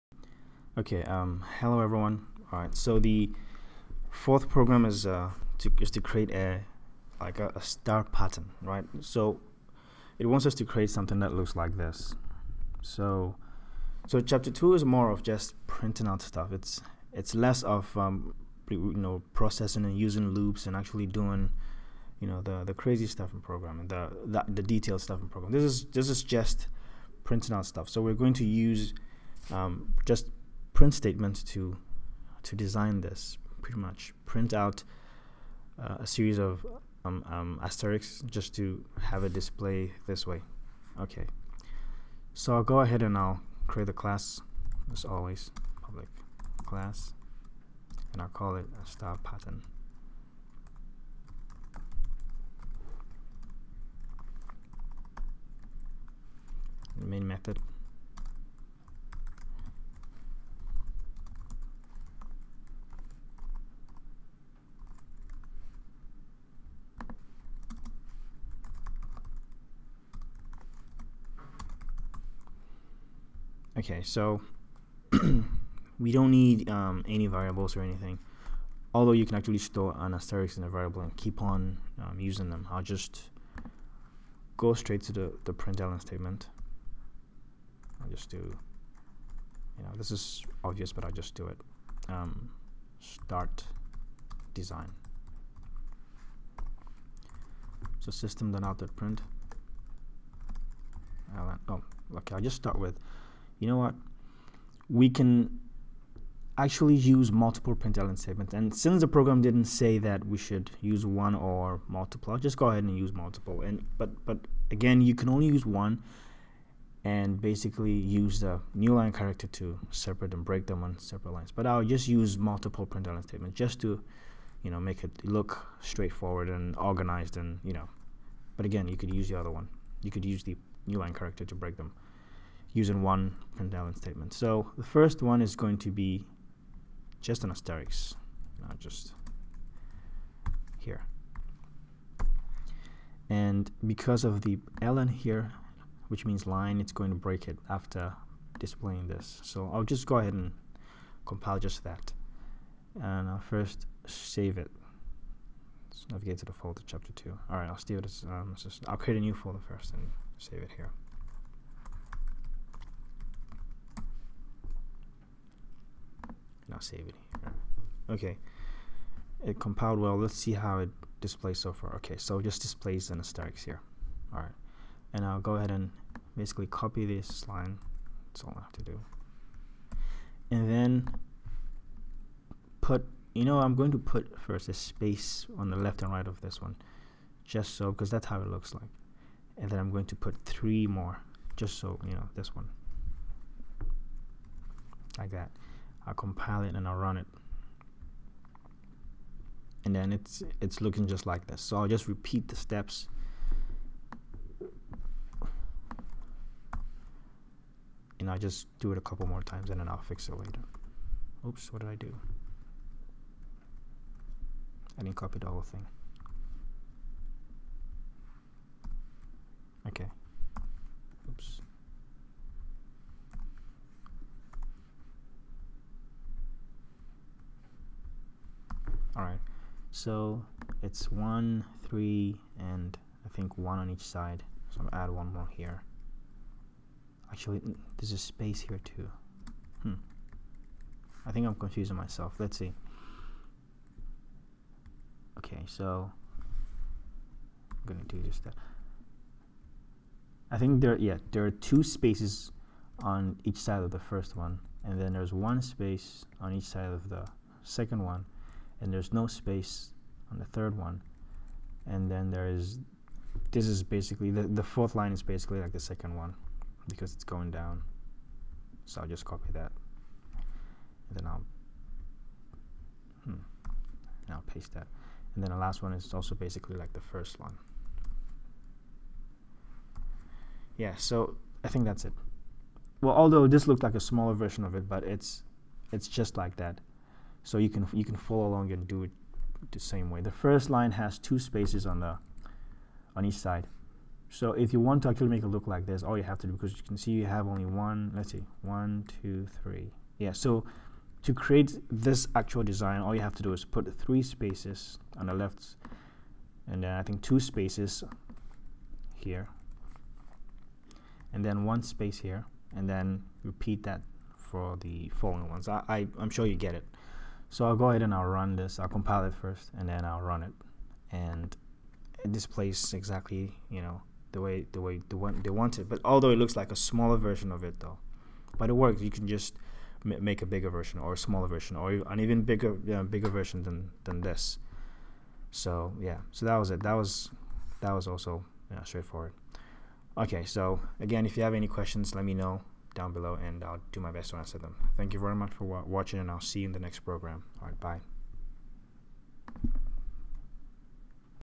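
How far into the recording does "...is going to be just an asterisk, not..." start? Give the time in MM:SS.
02:15.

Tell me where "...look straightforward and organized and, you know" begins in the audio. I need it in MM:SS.
02:05.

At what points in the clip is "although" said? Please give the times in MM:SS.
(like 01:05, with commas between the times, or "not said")
01:18, 04:43, 05:26.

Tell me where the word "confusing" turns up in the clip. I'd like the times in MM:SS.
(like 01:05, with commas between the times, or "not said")
04:01.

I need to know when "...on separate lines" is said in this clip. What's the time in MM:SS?
02:00.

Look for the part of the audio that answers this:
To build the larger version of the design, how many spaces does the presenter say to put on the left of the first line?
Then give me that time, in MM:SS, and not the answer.
05:03.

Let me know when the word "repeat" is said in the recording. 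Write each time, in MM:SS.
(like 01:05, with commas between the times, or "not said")
03:22, 05:13.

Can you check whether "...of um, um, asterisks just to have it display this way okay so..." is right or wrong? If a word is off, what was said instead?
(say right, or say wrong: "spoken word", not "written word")
right.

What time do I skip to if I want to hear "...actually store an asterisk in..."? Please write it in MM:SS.
01:19.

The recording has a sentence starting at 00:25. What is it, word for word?
This is this is just printing out stuff.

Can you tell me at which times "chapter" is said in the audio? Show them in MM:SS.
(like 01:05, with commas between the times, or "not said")
00:14, 02:36.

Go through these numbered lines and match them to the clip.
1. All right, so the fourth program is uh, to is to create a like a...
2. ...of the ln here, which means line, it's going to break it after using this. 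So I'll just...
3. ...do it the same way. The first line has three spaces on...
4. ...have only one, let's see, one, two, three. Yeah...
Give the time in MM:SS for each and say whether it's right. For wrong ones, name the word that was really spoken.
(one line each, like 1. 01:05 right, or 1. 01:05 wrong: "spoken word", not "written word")
1. 00:02 right
2. 02:24 wrong: "displaying", not "using"
3. 04:48 wrong: "two", not "three"
4. 04:57 right.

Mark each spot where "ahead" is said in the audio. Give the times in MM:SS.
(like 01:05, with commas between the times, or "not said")
00:42, 01:52, 02:30, 02:55, 05:17.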